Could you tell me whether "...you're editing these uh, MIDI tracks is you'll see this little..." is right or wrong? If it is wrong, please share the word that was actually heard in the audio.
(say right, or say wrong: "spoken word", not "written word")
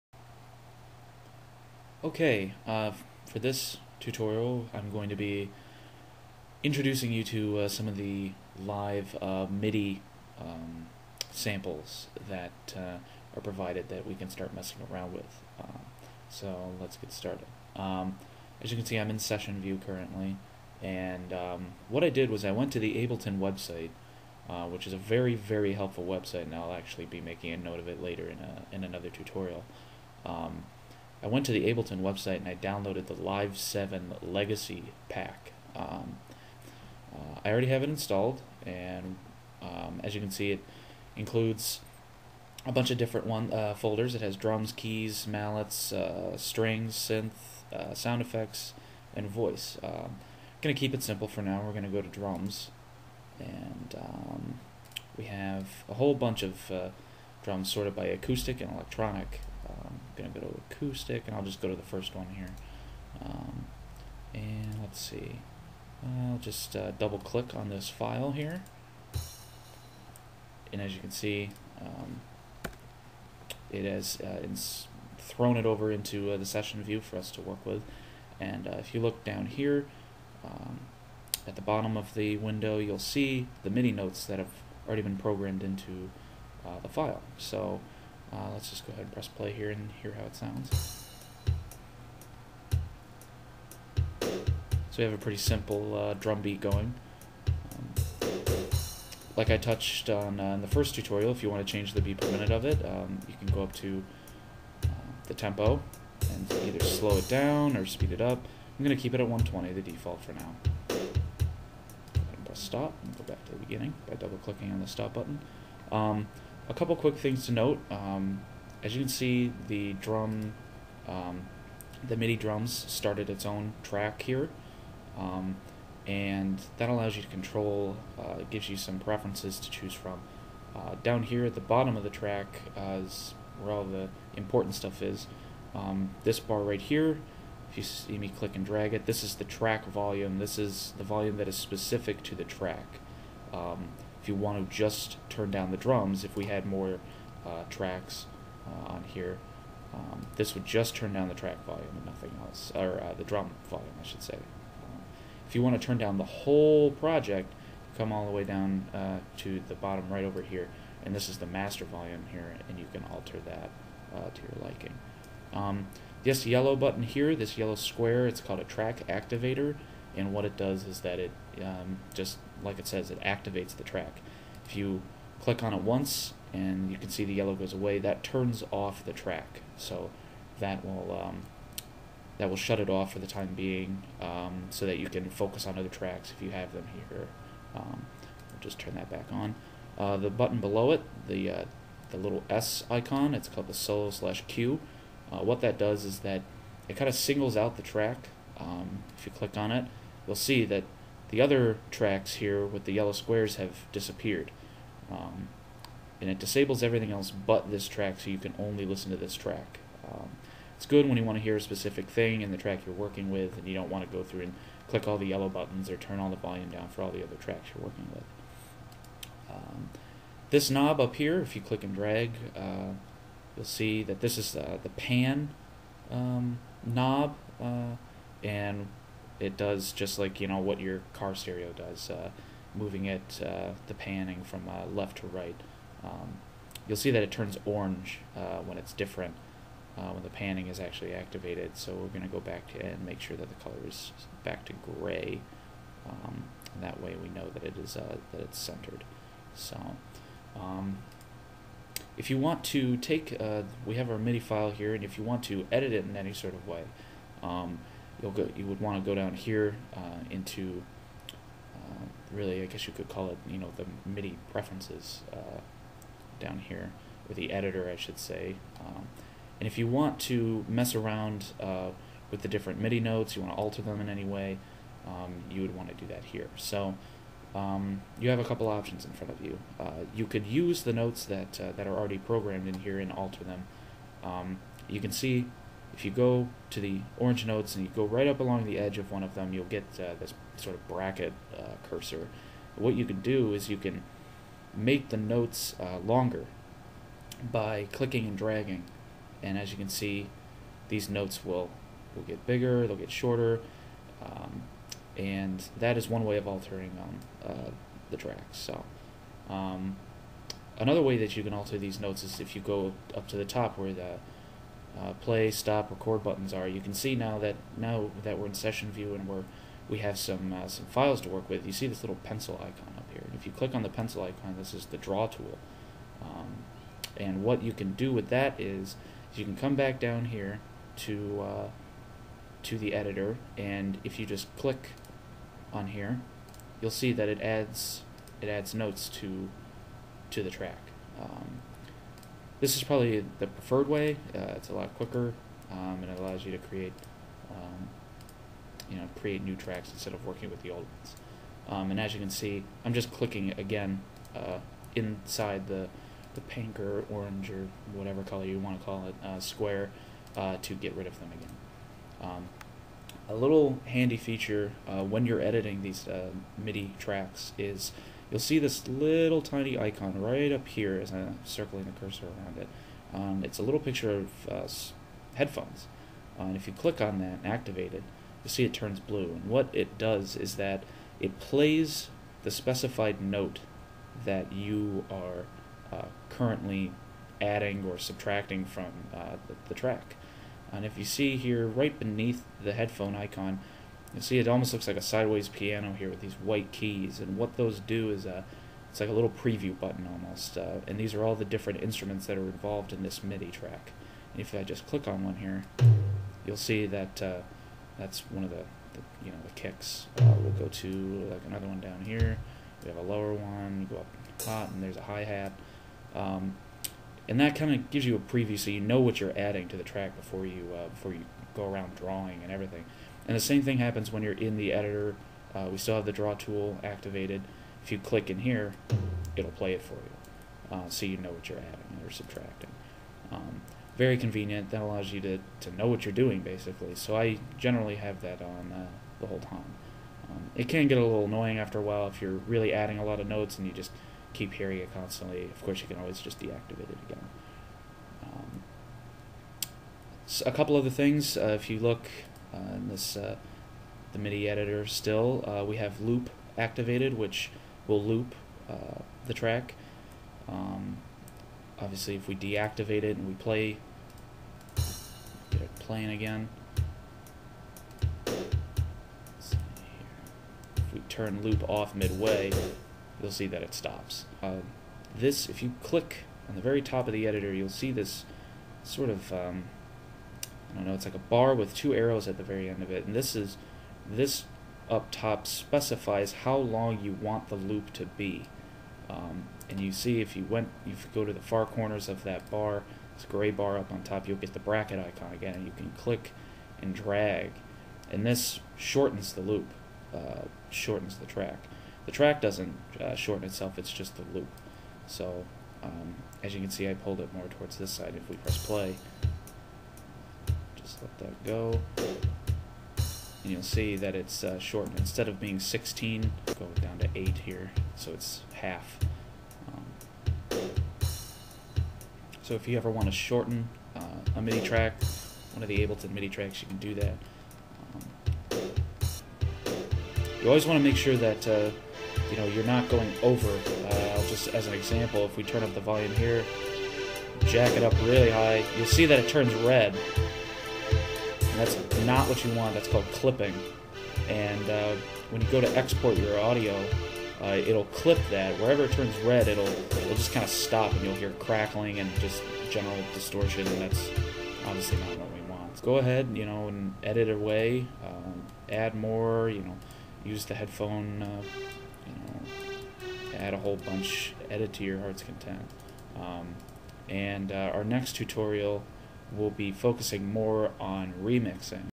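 right.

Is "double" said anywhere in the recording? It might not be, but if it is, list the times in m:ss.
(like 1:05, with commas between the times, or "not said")
1:06, 1:54.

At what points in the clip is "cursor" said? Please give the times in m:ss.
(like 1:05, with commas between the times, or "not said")
4:51, 6:12.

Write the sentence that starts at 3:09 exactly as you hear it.
Uh, the button below it, the, uh, the little S icon, it's called the solo slash cue.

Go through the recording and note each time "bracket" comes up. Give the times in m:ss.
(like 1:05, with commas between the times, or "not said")
4:50, 8:14.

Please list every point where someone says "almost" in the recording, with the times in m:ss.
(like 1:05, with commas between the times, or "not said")
6:34, 6:40.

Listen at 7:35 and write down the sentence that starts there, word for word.
Uh, we have loop activated, which will loop the track.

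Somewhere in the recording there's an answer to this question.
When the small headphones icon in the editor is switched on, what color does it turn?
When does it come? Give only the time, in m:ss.
6:19.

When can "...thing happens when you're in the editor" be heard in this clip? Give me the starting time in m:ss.
7:03.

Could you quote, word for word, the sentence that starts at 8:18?
And this shortens the loop, uh, shortens the track.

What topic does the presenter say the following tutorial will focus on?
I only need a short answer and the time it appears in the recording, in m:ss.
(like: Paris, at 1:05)
Remixing, at 9:31.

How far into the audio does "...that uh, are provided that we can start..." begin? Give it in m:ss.
0:12.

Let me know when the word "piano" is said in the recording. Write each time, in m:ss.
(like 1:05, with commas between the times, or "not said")
6:35.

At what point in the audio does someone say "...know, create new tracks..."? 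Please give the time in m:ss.
5:48.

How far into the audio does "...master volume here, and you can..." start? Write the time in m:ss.
2:41.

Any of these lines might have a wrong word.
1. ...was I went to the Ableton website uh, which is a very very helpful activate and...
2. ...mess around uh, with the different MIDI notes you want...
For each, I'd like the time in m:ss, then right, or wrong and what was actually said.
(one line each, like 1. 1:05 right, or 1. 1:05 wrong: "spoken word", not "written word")
1. 0:22 wrong: "website", not "activate"
2. 4:30 right.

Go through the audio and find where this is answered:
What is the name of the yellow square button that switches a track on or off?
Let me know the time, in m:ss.
2:48.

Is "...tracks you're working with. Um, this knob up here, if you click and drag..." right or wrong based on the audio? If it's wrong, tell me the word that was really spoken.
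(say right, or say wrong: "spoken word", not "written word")
right.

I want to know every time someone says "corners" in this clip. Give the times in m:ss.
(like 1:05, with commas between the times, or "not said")
8:11.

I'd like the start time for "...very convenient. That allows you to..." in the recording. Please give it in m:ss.
7:13.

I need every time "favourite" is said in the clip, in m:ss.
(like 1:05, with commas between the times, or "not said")
not said.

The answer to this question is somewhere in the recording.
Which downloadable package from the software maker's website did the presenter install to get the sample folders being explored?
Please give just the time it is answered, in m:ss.
0:33.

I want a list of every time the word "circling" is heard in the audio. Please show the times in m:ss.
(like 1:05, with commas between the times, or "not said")
6:11.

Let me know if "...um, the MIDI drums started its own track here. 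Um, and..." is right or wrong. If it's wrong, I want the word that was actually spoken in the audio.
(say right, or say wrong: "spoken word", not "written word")
right.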